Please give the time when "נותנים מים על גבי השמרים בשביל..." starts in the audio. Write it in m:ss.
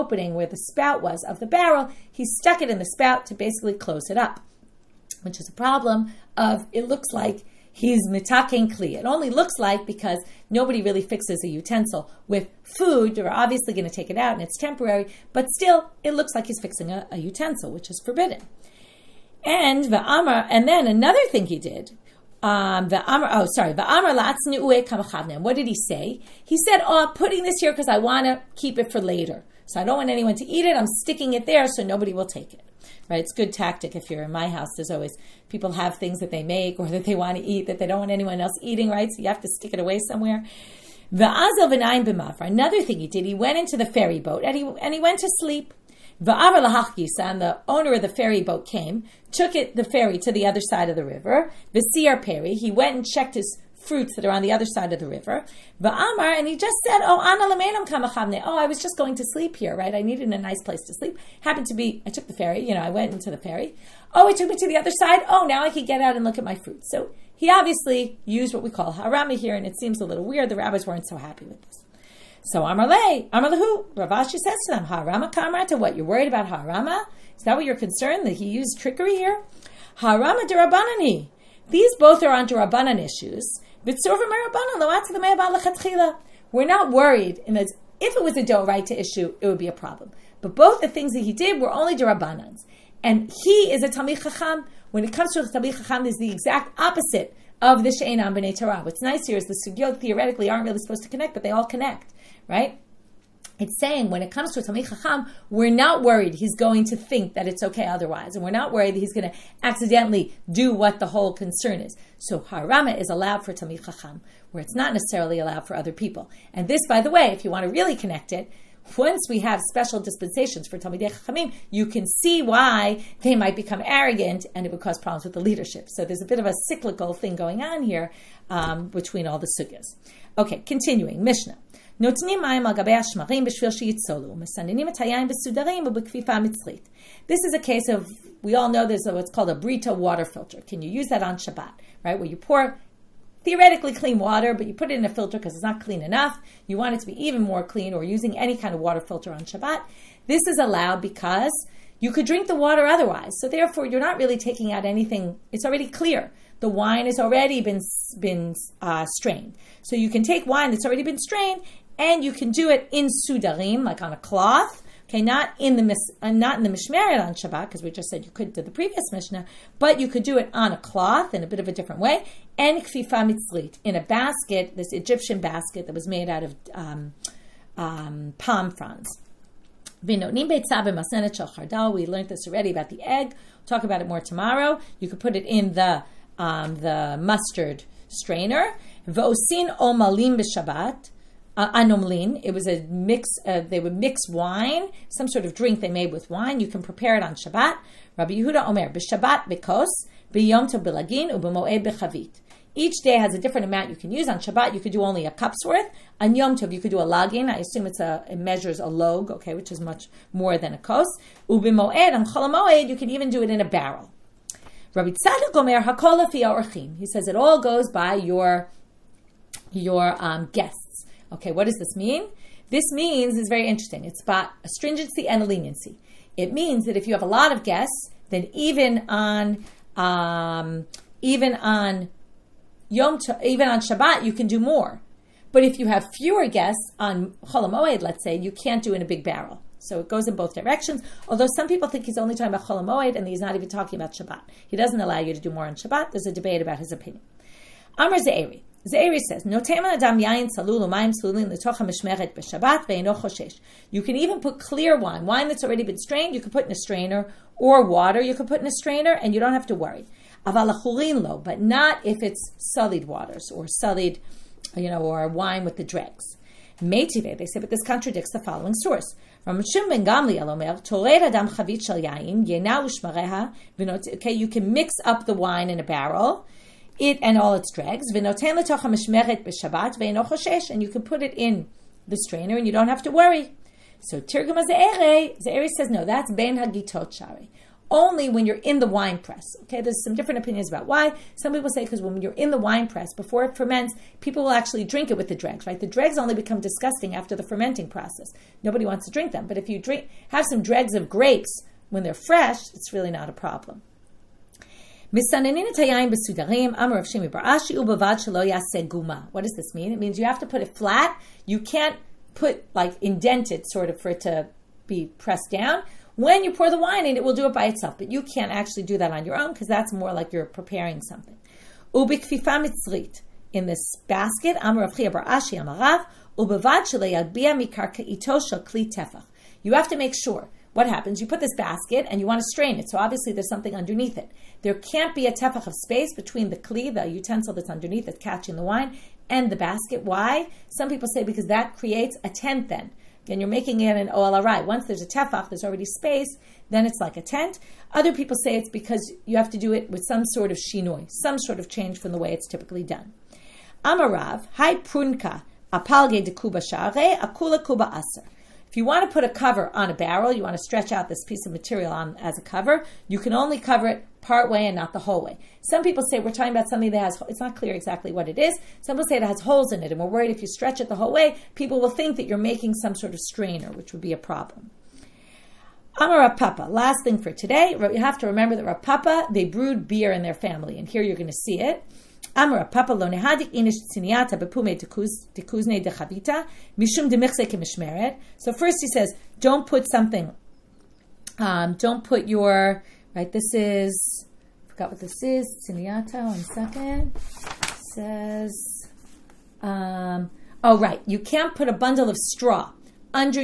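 2:11.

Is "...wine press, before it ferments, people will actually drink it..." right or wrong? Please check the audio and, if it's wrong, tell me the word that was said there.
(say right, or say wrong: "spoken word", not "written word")
right.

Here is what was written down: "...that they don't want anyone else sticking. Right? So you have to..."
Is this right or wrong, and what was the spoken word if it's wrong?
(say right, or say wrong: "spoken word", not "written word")
wrong: "eating", not "sticking".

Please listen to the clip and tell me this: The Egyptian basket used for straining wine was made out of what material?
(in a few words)
palm fronds.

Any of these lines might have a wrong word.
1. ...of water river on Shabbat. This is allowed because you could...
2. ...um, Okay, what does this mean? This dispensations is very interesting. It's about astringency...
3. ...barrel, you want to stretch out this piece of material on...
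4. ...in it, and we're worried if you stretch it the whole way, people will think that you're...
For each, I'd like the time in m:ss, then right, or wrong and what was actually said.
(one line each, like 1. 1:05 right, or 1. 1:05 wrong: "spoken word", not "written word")
1. 2:28 wrong: "filter", not "river"
2. 3:40 wrong: "means", not "dispensations"
3. 5:59 right
4. 6:09 right.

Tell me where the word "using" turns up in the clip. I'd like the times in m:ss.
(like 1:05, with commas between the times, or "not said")
2:28.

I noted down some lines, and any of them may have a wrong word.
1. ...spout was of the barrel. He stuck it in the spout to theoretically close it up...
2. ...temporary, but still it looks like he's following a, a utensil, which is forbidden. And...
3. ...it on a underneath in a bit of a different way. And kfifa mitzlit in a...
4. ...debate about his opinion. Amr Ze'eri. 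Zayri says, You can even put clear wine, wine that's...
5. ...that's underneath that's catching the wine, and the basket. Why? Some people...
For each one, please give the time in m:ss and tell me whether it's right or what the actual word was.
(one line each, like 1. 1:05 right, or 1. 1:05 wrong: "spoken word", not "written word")
1. 0:00 wrong: "basically", not "theoretically"
2. 0:14 wrong: "fixing", not "following"
3. 2:50 wrong: "cloth", not "underneath"
4. 4:06 right
5. 5:37 right.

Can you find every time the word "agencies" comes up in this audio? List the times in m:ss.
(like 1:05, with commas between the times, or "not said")
not said.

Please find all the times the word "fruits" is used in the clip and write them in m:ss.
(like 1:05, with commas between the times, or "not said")
0:53, 1:06.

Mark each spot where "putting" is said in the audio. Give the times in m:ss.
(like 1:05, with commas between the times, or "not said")
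0:27.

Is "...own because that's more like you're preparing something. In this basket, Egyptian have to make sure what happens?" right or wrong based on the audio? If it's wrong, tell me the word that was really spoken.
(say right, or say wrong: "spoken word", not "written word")
wrong: "You", not "Egyptian".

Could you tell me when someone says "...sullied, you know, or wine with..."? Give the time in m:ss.
4:23.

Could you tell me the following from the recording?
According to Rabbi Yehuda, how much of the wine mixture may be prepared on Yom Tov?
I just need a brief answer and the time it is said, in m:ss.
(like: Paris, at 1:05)
a lagin, at 3:26.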